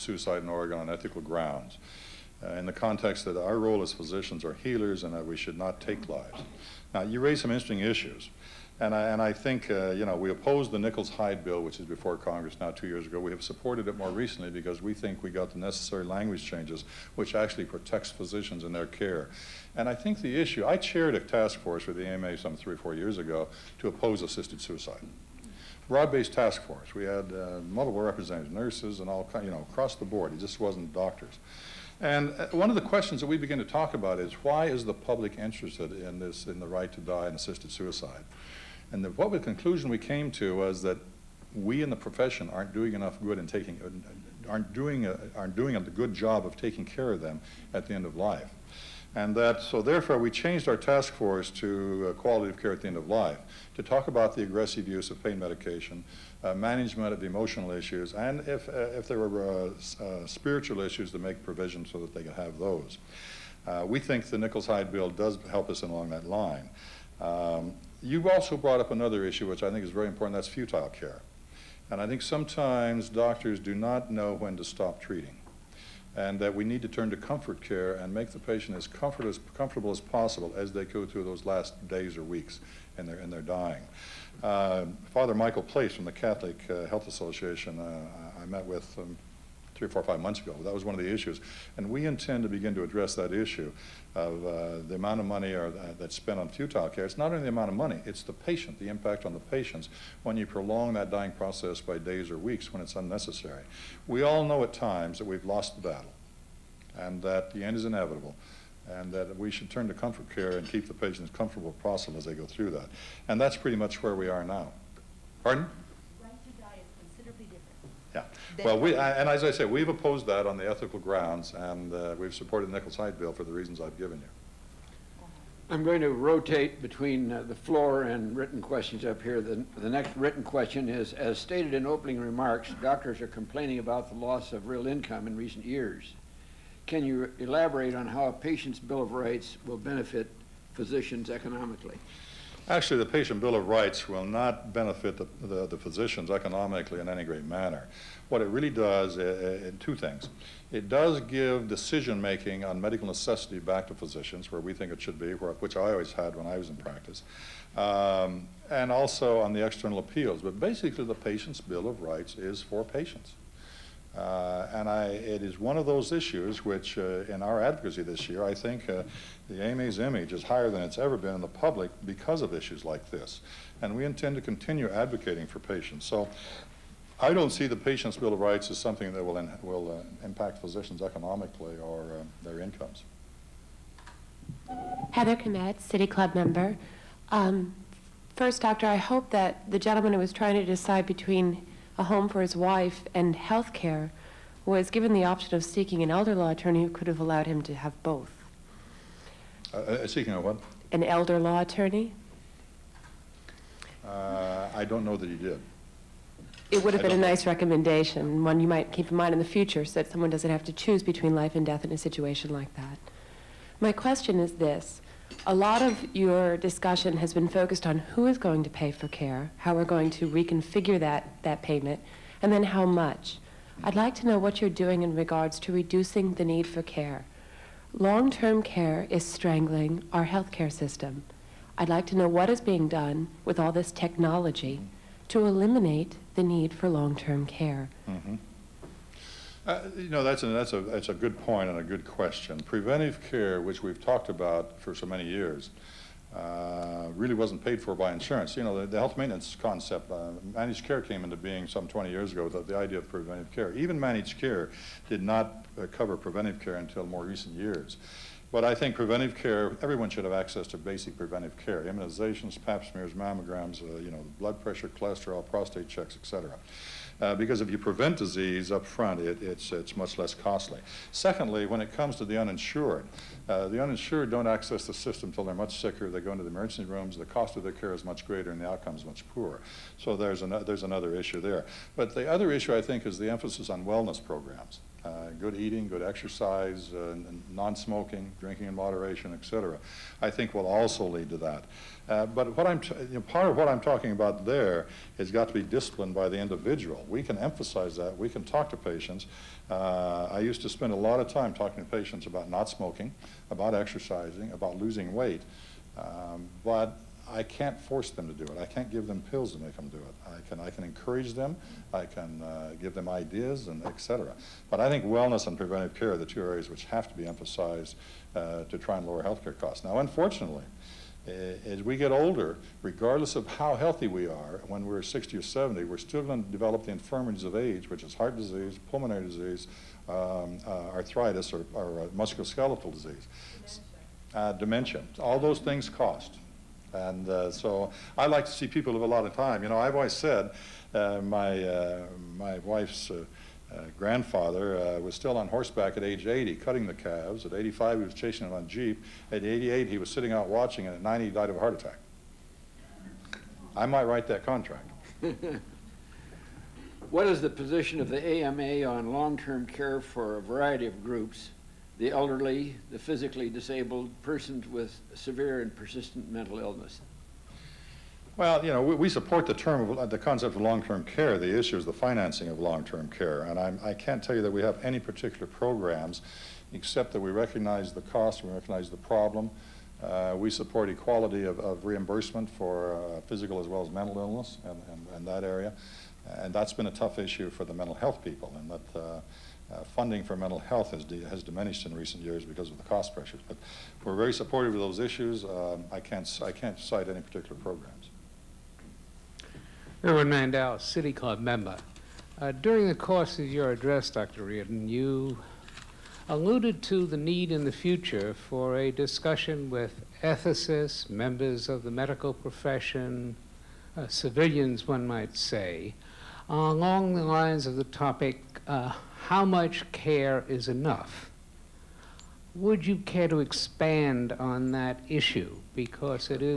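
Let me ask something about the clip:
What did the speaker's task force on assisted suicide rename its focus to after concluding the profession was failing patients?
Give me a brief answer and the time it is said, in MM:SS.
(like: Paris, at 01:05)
quality of care at the end of life, at 00:52.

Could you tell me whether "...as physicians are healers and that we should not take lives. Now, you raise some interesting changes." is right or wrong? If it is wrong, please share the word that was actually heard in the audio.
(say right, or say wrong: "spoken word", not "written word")
wrong: "issues", not "changes".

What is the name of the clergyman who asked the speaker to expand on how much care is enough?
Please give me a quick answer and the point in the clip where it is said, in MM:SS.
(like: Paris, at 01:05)
Reverend Mandel, at 06:40.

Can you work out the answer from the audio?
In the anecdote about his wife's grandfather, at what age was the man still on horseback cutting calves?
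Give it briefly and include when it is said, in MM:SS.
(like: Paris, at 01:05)
80, at 05:46.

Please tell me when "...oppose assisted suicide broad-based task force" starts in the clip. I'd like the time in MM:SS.
00:23.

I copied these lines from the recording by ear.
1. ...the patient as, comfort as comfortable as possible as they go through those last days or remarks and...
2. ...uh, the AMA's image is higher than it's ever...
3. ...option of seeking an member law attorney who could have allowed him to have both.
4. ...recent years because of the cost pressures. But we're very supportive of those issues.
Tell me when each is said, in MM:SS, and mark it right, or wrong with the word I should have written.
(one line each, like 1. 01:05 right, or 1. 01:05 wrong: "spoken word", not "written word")
1. 01:18 wrong: "weeks", not "remarks"
2. 02:48 right
3. 03:15 wrong: "elder", not "member"
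4. 06:31 right.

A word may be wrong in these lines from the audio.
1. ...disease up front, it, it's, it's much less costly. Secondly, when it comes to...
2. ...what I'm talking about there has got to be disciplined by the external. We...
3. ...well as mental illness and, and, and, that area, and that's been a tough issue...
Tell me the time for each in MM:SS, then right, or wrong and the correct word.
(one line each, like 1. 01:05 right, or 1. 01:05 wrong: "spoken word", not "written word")
1. 04:28 right
2. 04:53 wrong: "individual", not "external"
3. 06:23 right.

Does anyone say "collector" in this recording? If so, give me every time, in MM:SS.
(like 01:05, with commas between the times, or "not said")
not said.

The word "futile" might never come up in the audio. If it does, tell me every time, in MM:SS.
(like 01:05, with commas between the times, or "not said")
01:10, 01:36.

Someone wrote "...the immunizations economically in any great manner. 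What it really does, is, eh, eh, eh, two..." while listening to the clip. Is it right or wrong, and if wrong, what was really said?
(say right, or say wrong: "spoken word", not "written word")
wrong: "physicians", not "immunizations".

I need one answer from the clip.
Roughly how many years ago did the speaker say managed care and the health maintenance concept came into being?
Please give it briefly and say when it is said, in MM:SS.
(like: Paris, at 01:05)
20, at 04:11.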